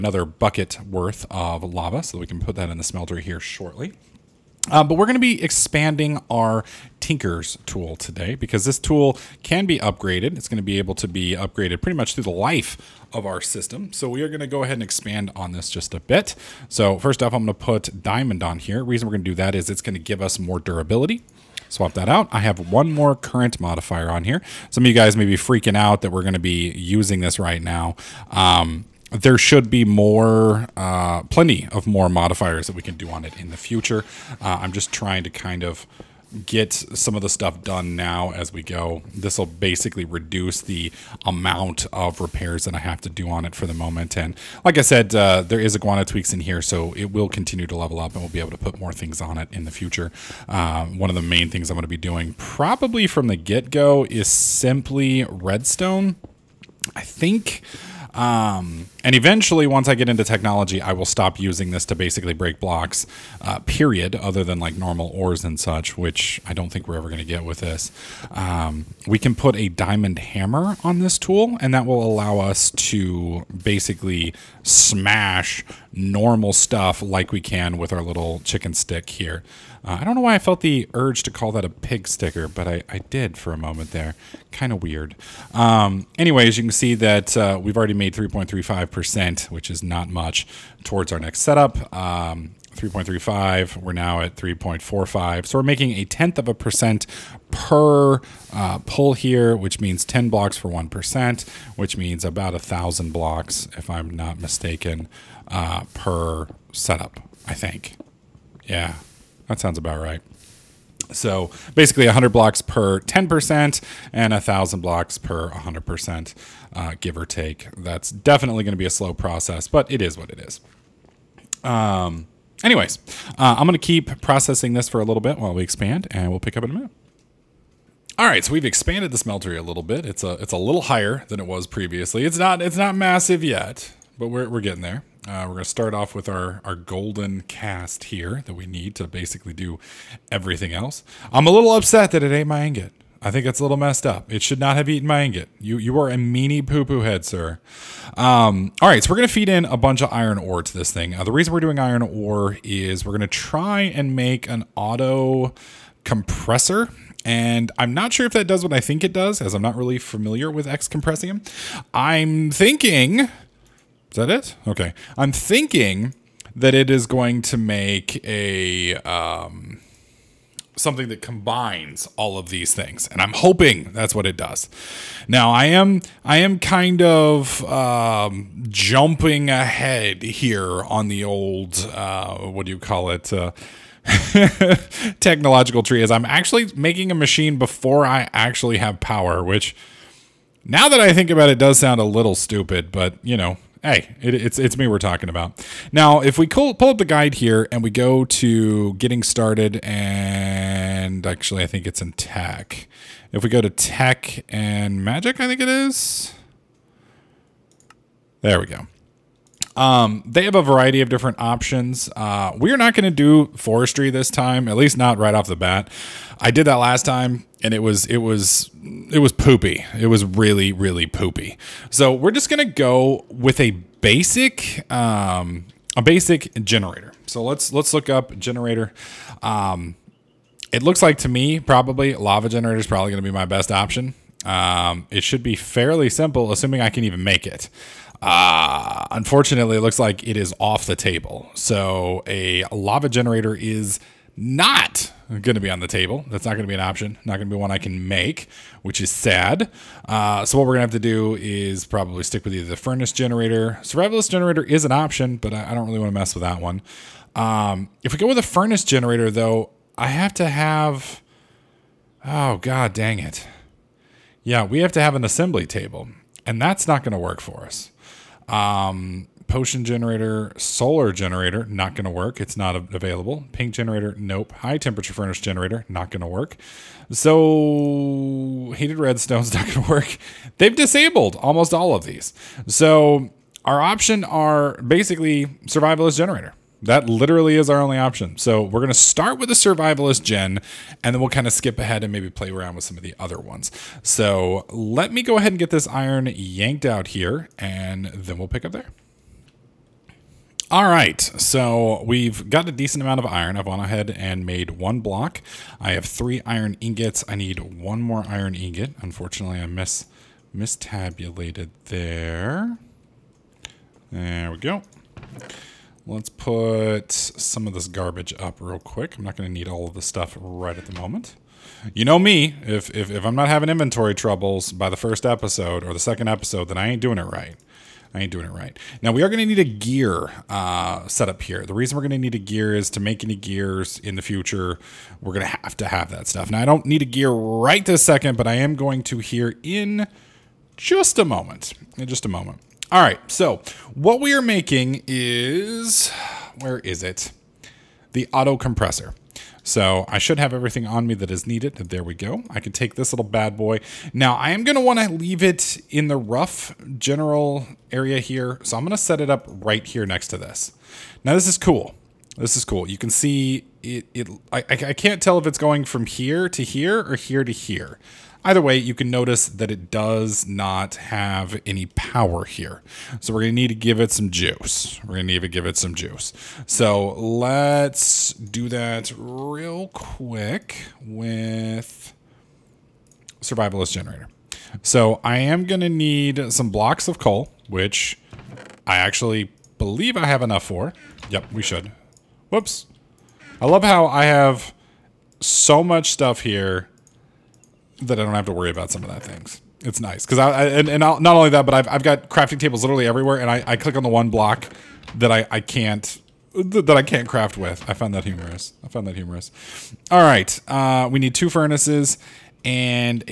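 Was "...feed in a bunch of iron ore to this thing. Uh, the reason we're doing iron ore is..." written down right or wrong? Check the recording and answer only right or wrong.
right.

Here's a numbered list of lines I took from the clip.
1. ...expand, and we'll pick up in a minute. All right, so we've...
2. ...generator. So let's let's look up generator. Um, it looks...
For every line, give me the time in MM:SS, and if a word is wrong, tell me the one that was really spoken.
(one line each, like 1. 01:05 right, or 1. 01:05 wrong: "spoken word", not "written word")
1. 02:05 right
2. 03:46 right.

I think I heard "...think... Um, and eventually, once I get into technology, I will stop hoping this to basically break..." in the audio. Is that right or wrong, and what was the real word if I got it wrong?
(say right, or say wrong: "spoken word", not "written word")
wrong: "using", not "hoping".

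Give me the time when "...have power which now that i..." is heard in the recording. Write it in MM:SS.
03:08.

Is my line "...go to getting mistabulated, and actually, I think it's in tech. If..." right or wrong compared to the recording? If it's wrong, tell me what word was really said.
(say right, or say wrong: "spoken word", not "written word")
wrong: "started", not "mistabulated".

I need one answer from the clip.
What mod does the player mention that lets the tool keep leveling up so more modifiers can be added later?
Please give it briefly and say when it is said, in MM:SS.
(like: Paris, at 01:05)
Iguana Tweaks, at 00:45.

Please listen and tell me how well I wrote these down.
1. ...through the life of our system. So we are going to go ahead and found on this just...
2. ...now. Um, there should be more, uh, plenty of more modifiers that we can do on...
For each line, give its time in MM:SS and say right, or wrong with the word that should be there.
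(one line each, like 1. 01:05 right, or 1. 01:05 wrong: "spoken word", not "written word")
1. 00:12 wrong: "expand", not "found"
2. 00:27 right.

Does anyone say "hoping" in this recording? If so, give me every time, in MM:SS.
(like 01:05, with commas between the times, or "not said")
02:53.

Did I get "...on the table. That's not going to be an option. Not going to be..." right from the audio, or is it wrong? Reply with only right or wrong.
right.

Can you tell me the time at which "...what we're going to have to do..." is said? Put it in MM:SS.
04:10.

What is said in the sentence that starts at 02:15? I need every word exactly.
Uh, we're going to start off with our, our golden cast here that we need to basically do everything else.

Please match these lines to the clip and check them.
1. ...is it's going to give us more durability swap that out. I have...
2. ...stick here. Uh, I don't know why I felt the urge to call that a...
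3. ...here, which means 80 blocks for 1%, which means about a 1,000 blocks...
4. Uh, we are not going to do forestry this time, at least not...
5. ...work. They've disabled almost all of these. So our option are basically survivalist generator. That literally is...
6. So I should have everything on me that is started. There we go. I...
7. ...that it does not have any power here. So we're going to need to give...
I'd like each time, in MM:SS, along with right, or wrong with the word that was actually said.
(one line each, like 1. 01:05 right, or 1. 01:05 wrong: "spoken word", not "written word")
1. 00:19 right
2. 01:18 right
3. 01:39 wrong: "10", not "80"
4. 03:32 right
5. 04:39 right
6. 05:49 wrong: "needed", not "started"
7. 06:09 right.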